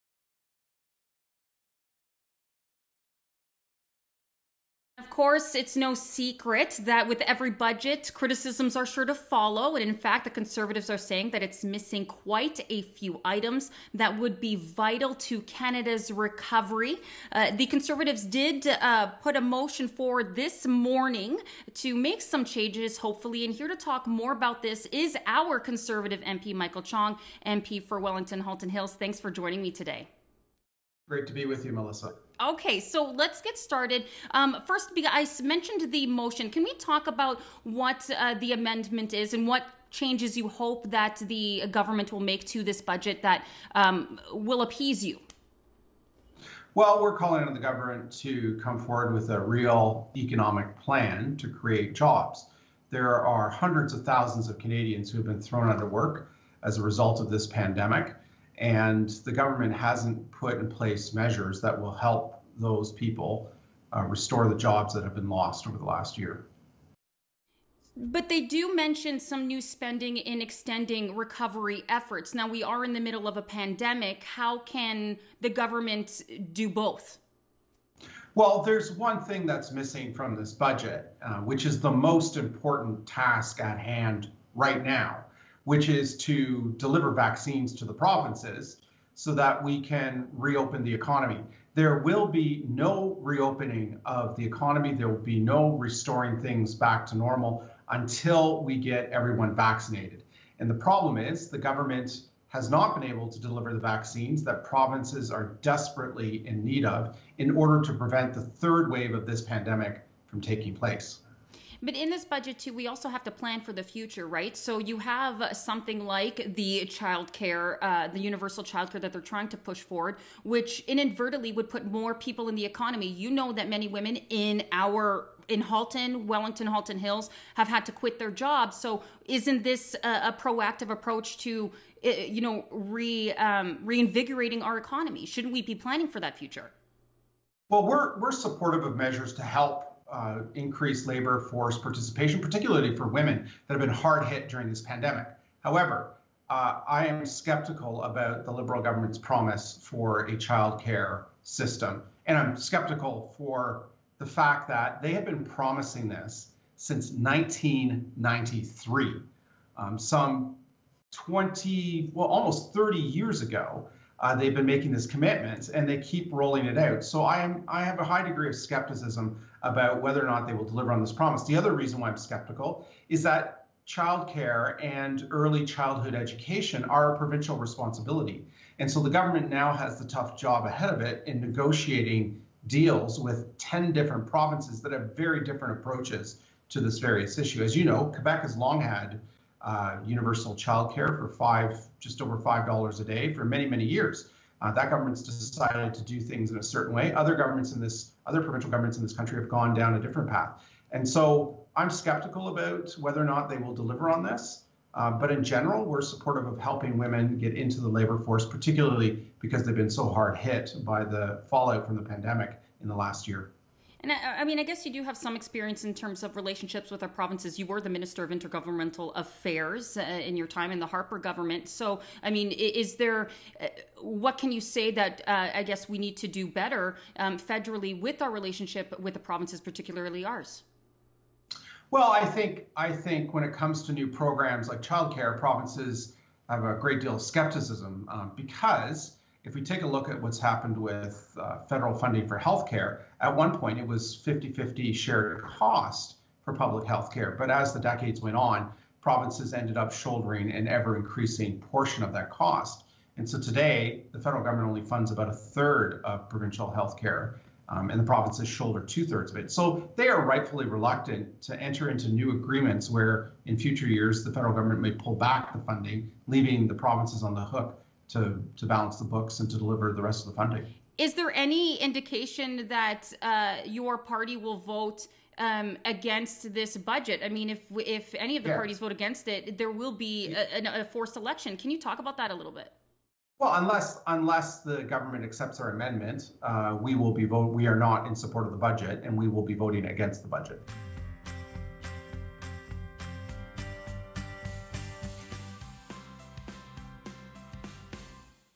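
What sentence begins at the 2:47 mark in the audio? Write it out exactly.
So I am I have a high degree of skepticism about whether or not they will deliver on this promise.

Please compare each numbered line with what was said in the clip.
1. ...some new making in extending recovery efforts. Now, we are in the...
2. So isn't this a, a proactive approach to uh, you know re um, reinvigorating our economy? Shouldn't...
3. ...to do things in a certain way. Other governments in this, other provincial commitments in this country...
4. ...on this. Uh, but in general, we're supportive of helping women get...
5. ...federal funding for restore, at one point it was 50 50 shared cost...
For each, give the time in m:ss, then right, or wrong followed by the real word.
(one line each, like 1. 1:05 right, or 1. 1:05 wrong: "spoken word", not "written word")
1. 1:09 wrong: "spending", not "making"
2. 2:08 right
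3. 3:15 wrong: "governments", not "commitments"
4. 3:24 right
5. 4:01 wrong: "healthcare", not "restore".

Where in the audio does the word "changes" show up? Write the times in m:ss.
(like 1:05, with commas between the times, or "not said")
0:22, 0:39.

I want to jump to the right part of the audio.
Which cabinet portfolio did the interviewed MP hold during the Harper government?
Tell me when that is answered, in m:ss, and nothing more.
3:37.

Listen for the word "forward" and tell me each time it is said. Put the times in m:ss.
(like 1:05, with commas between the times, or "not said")
0:19, 0:48, 1:59.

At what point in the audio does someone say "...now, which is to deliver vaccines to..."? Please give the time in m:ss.
1:24.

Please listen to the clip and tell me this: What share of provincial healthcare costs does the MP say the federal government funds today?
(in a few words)
a third.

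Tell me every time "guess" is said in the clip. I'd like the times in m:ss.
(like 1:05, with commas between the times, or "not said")
3:34, 3:45.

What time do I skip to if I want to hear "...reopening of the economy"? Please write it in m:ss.
1:33.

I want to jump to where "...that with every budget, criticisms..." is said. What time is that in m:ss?
0:06.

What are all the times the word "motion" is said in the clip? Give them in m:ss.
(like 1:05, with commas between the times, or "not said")
0:19, 0:36.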